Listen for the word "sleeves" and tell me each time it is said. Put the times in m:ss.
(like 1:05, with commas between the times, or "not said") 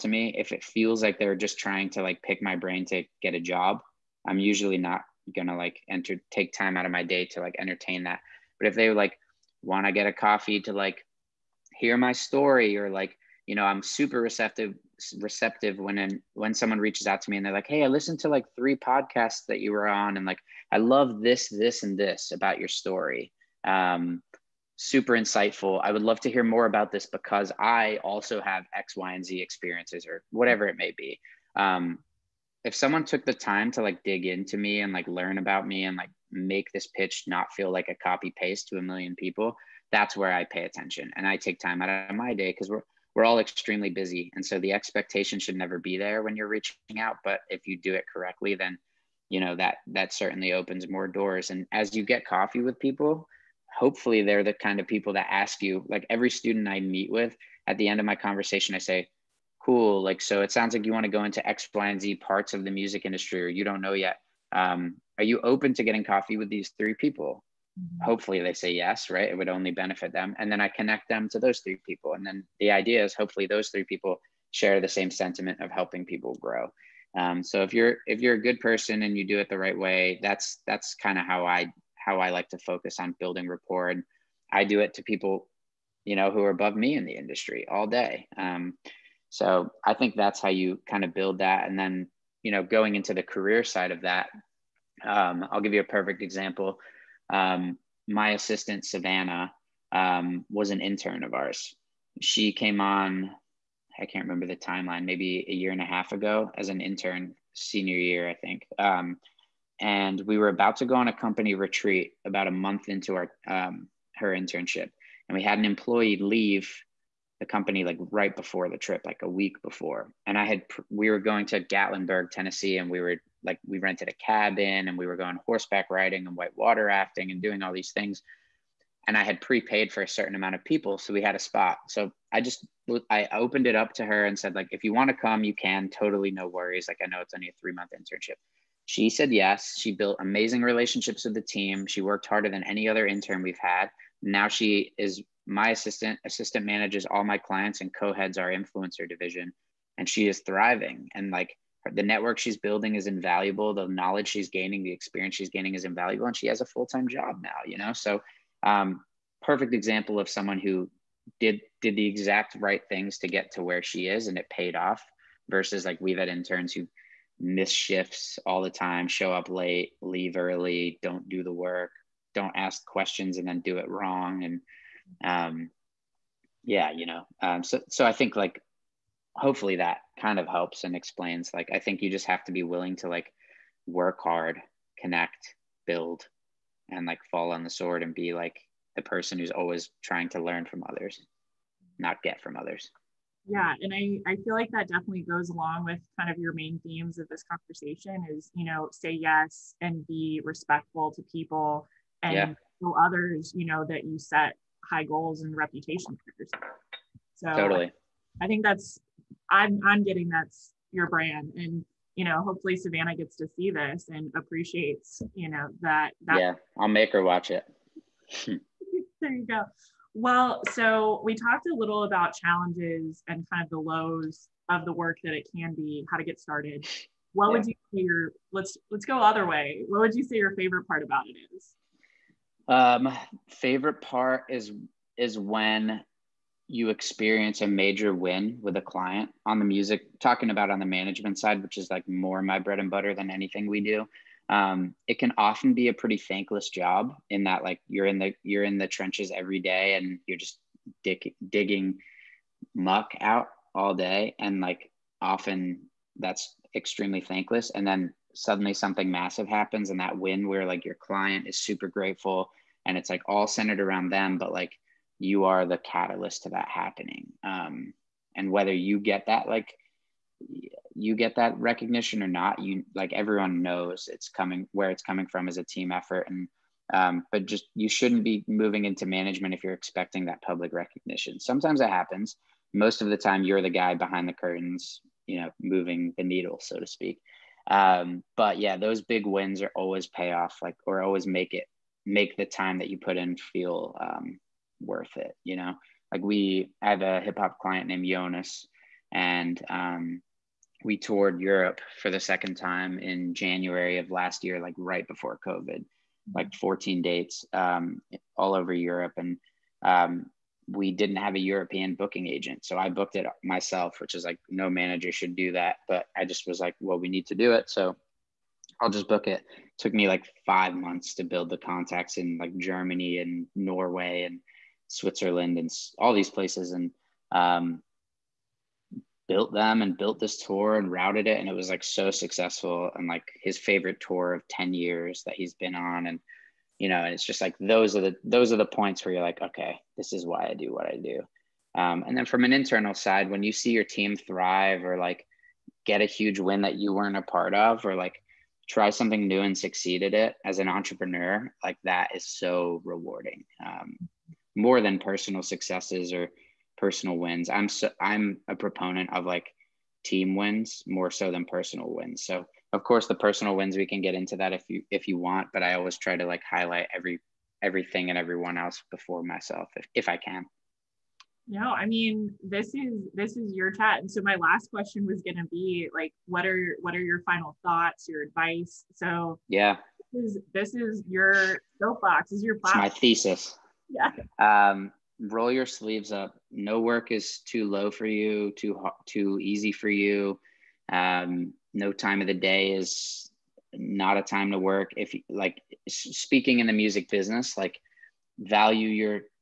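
6:25.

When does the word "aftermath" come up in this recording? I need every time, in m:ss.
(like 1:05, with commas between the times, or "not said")
not said.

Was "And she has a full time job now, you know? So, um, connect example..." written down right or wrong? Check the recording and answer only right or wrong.
wrong.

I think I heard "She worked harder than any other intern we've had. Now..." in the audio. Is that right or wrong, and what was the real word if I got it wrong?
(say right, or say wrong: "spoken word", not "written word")
right.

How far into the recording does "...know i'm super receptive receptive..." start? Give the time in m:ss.
0:13.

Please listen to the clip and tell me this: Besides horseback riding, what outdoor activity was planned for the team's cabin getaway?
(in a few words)
Whitewater rafting.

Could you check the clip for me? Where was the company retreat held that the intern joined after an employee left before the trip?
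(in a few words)
Gatlinburg, Tennessee.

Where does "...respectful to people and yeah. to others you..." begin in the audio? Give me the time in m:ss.
3:20.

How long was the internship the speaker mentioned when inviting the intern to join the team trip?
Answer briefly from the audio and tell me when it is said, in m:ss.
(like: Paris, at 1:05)
3 months, at 2:17.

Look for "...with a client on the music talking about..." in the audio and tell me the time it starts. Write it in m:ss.
3:58.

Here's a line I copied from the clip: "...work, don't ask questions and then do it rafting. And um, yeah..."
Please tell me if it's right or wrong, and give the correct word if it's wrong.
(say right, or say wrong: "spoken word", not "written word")
wrong: "wrong", not "rafting".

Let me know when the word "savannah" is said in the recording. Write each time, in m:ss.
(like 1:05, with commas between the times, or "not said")
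1:38, 3:32.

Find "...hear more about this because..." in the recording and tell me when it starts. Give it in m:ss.
0:26.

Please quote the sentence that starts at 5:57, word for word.
I'm so I'm a proponent of like team wins more so than personal wins.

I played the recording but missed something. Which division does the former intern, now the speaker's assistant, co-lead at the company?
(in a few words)
Influencer division.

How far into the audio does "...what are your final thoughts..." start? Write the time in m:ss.
6:16.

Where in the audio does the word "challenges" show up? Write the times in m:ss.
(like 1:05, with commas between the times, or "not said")
3:42.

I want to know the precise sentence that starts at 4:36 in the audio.
And um, but just you shouldn't be moving into management if you're expecting that public recognition.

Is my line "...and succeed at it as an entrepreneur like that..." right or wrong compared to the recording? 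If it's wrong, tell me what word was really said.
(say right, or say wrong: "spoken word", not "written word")
right.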